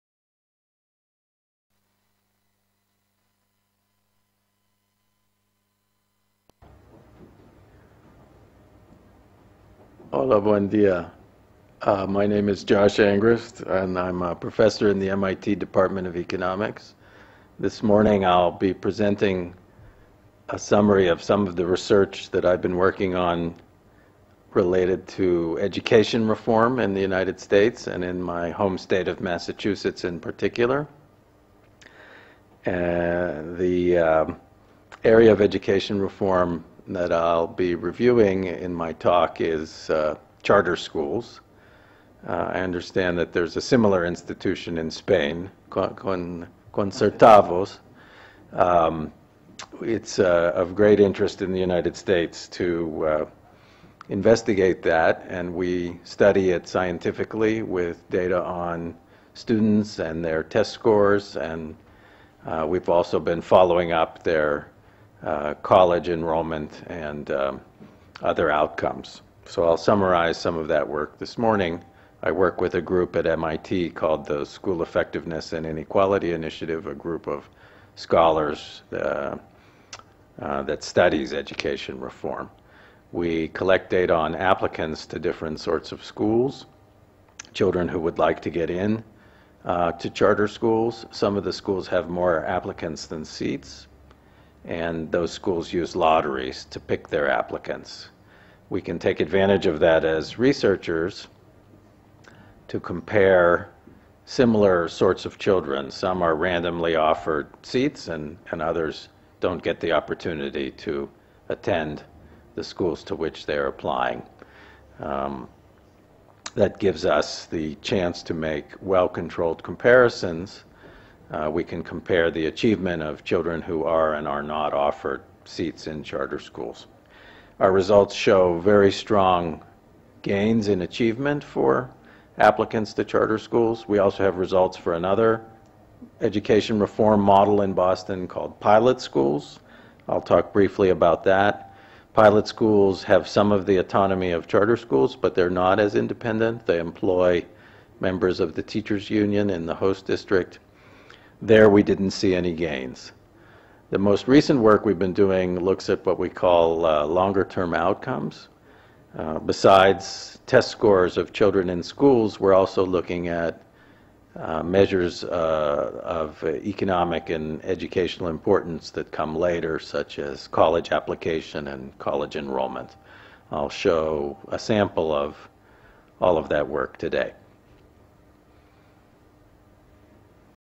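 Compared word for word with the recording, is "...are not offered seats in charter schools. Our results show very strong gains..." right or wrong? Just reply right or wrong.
right.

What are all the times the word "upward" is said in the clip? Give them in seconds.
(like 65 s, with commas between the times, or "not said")
not said.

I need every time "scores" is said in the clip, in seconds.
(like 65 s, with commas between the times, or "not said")
60 s, 160 s.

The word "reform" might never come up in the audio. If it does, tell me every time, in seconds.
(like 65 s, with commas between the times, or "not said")
26 s, 36 s, 81 s, 136 s.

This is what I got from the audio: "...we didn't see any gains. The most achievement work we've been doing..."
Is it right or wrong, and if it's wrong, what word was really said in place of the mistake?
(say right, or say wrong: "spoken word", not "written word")
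wrong: "recent", not "achievement".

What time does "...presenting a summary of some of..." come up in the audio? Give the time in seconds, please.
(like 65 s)
18 s.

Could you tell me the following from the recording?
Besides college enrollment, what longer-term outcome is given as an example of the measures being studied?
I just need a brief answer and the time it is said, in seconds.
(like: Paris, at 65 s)
College application, at 170 s.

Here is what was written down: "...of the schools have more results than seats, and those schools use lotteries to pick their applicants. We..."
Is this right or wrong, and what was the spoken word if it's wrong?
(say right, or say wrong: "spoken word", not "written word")
wrong: "applicants", not "results".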